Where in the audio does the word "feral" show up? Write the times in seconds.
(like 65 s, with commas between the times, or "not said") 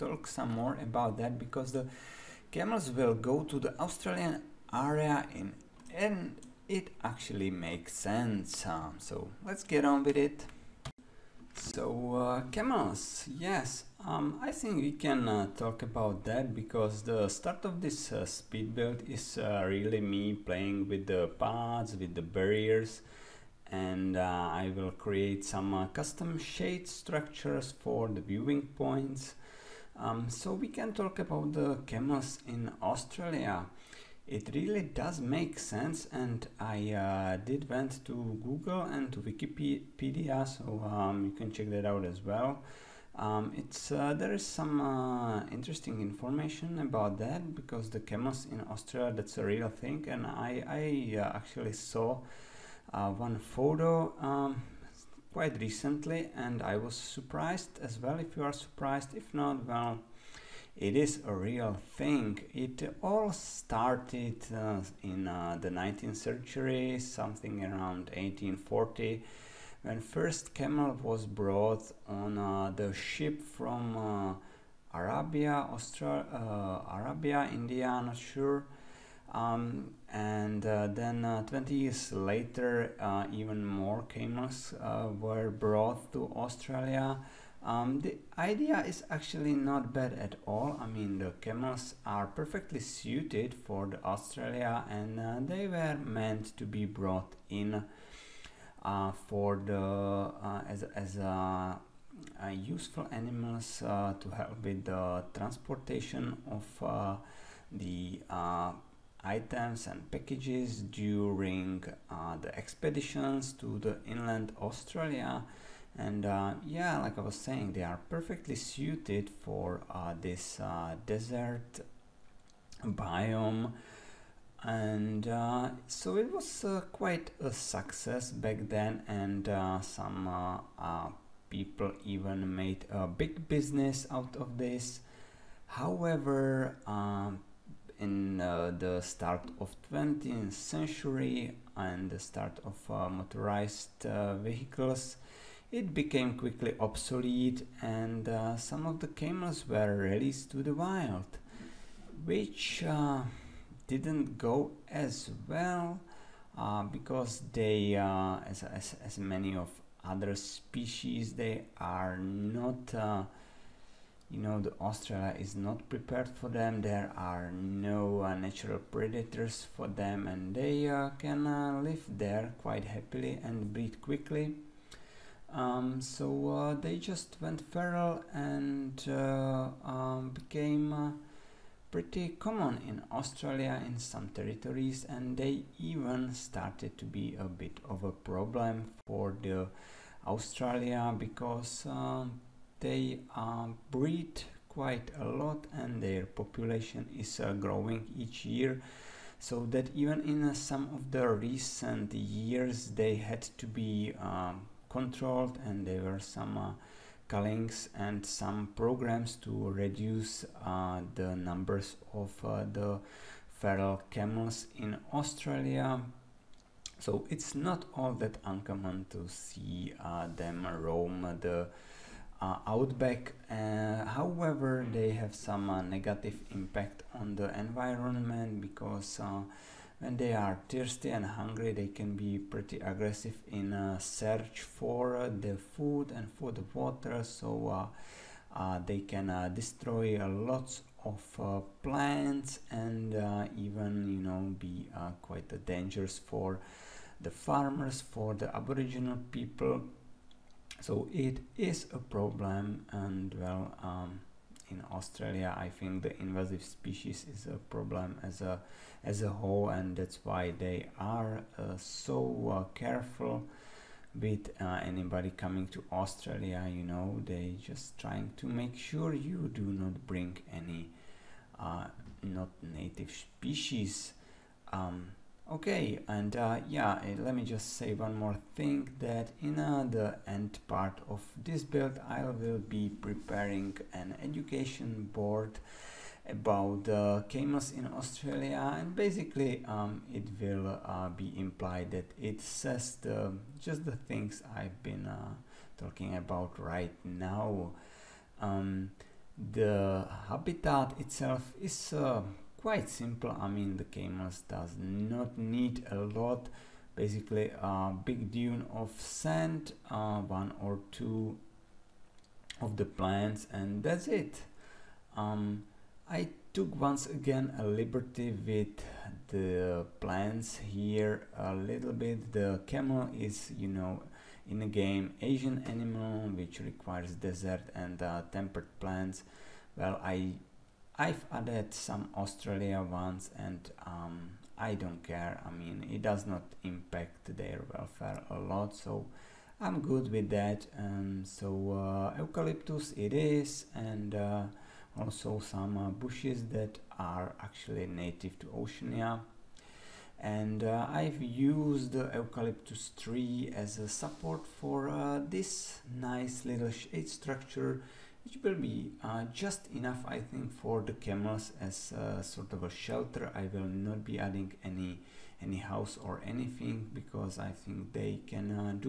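177 s, 213 s.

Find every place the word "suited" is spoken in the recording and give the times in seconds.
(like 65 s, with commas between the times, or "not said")
92 s, 118 s.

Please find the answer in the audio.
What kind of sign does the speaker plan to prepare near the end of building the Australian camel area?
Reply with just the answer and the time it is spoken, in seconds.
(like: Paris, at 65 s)
Education board, at 284 s.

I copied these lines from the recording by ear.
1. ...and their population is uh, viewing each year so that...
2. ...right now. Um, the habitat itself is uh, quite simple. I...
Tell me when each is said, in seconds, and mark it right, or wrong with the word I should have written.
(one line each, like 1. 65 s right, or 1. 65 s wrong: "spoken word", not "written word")
1. 195 s wrong: "growing", not "viewing"
2. 296 s right.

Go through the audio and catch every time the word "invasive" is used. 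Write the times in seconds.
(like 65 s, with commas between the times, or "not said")
256 s.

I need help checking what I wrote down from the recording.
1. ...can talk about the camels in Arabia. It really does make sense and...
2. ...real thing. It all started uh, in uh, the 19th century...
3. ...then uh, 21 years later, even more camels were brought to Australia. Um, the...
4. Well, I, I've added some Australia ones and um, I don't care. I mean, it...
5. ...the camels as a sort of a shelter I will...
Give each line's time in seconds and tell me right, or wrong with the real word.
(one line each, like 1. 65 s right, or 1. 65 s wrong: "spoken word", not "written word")
1. 30 s wrong: "Australia", not "Arabia"
2. 61 s right
3. 80 s wrong: "20", not "21"
4. 329 s right
5. 360 s right.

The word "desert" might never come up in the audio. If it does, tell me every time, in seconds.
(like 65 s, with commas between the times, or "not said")
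121 s, 327 s.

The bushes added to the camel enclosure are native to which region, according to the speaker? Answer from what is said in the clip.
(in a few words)
Oceania.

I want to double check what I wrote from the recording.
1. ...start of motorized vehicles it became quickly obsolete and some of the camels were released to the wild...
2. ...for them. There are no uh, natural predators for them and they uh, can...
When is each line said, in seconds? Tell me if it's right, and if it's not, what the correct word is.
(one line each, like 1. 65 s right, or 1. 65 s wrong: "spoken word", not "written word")
1. 142 s right
2. 166 s right.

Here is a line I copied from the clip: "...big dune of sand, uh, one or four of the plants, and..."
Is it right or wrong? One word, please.
wrong.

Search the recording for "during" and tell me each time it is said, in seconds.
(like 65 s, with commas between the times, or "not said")
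110 s.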